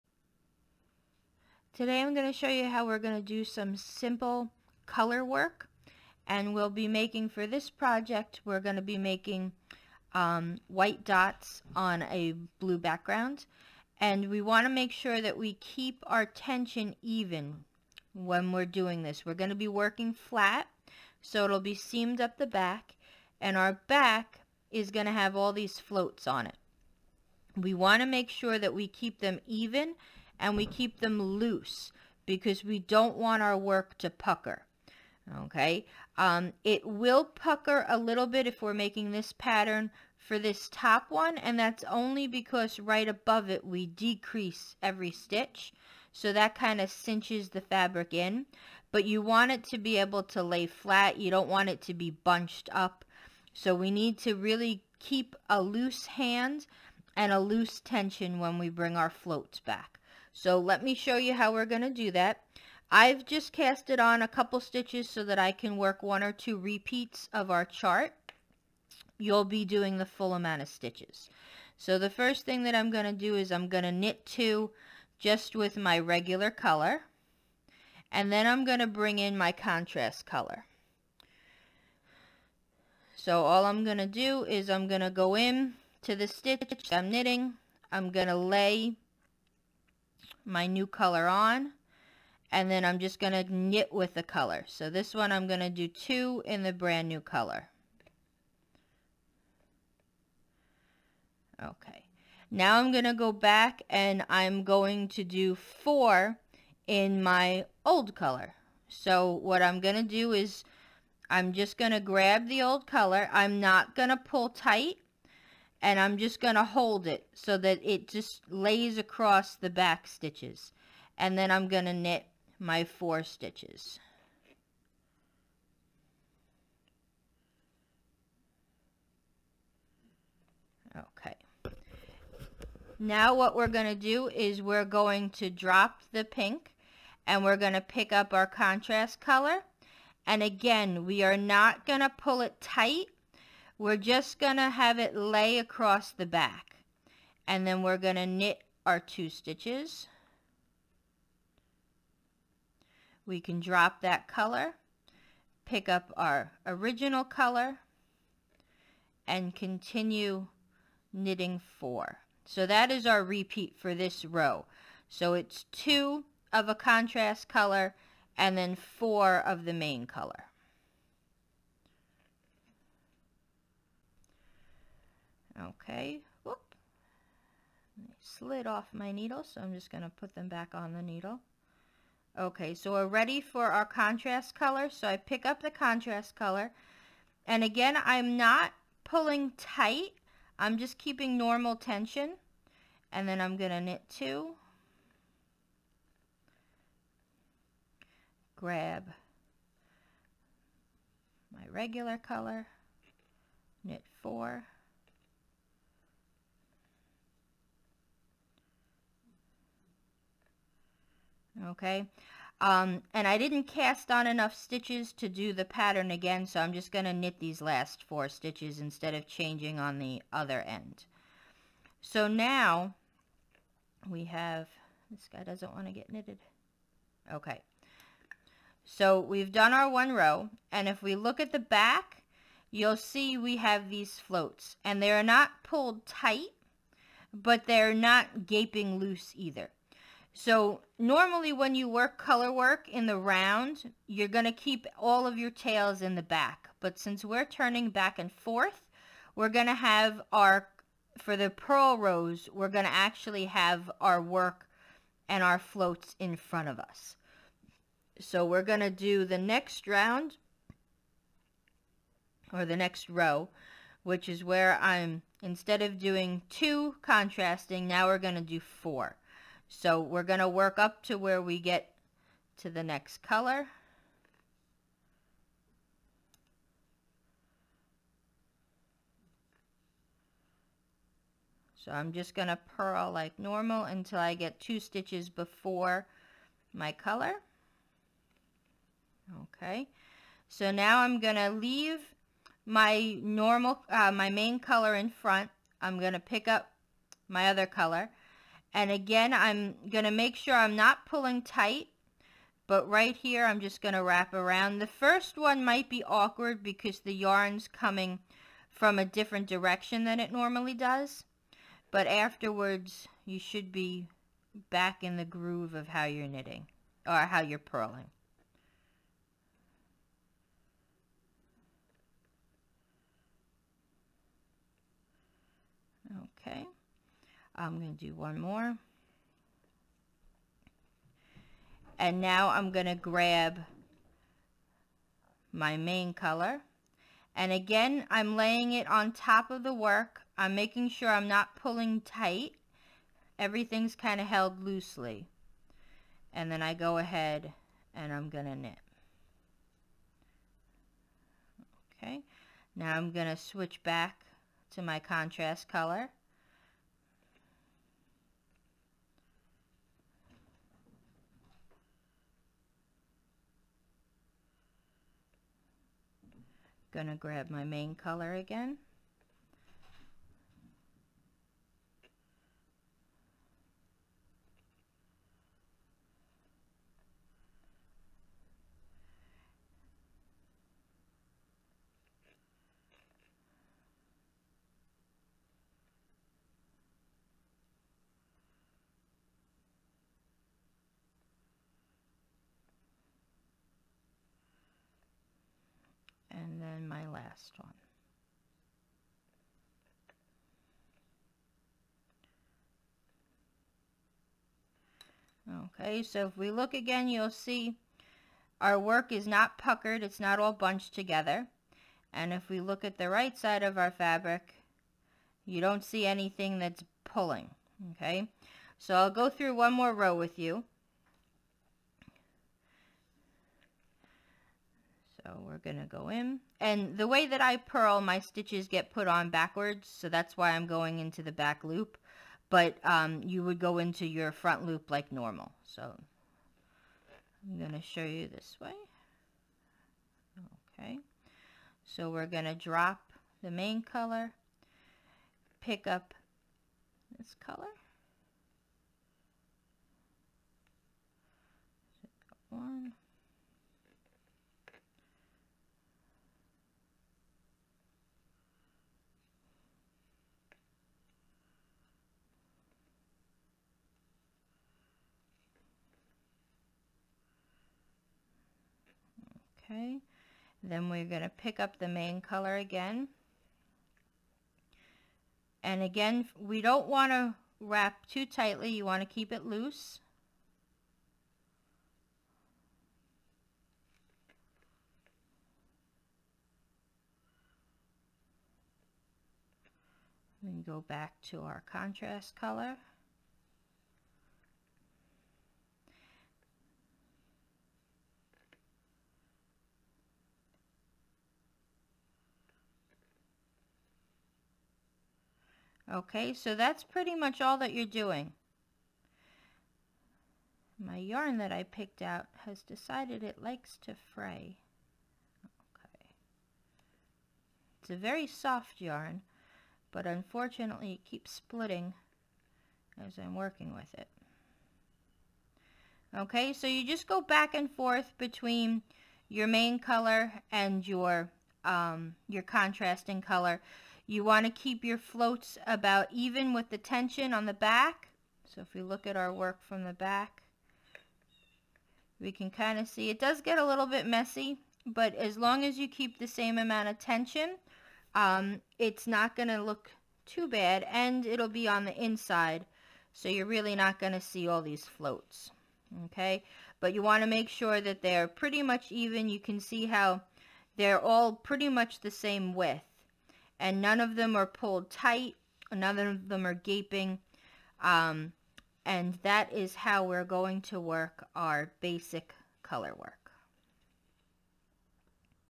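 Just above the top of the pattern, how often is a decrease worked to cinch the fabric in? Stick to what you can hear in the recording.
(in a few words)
Every stitch.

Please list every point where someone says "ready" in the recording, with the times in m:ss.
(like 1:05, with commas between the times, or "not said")
3:03.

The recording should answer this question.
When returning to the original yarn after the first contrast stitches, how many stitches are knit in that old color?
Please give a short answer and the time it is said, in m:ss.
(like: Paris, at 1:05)
4, at 1:45.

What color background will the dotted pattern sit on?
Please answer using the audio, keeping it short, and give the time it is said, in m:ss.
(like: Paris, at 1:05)
Blue, at 0:12.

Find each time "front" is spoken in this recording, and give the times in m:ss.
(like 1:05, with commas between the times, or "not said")
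4:16, 4:55, 7:14.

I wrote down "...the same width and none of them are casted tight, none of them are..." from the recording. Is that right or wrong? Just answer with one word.
wrong.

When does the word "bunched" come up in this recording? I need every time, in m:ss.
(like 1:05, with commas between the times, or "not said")
0:52, 6:50.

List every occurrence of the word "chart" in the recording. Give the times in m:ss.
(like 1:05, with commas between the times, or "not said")
1:07.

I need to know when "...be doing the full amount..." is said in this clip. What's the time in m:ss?
1:09.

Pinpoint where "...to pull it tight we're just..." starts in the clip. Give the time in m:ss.
2:22.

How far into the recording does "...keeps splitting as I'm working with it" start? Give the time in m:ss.
8:41.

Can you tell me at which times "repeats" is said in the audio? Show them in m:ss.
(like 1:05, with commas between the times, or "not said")
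1:06, 2:43.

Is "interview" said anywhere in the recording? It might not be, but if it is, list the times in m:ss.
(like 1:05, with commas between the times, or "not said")
not said.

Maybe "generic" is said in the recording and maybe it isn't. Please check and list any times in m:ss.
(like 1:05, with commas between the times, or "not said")
not said.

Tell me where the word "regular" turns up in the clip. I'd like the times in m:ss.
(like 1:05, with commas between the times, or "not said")
1:15, 3:21.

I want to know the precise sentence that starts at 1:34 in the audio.
So this one I'm going to do two in the brand new color.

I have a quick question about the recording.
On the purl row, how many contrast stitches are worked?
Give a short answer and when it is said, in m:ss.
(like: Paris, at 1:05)
4, at 4:27.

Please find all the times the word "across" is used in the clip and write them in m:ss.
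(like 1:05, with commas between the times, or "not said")
1:58, 2:25.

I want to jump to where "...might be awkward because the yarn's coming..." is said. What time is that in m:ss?
5:05.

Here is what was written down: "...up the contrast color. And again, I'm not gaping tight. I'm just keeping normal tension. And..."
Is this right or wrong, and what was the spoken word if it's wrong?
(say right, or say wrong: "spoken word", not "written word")
wrong: "pulling", not "gaping".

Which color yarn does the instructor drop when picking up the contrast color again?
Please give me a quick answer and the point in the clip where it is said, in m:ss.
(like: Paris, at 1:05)
Pink, at 2:16.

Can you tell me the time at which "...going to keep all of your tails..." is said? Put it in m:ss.
4:04.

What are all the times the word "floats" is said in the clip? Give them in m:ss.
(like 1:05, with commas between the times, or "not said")
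0:25, 0:59, 3:54, 4:15, 8:54, 9:14.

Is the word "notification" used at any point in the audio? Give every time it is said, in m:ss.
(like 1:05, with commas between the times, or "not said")
not said.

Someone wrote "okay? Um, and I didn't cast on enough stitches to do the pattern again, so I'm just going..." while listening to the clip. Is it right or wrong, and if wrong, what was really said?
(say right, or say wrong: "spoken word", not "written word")
right.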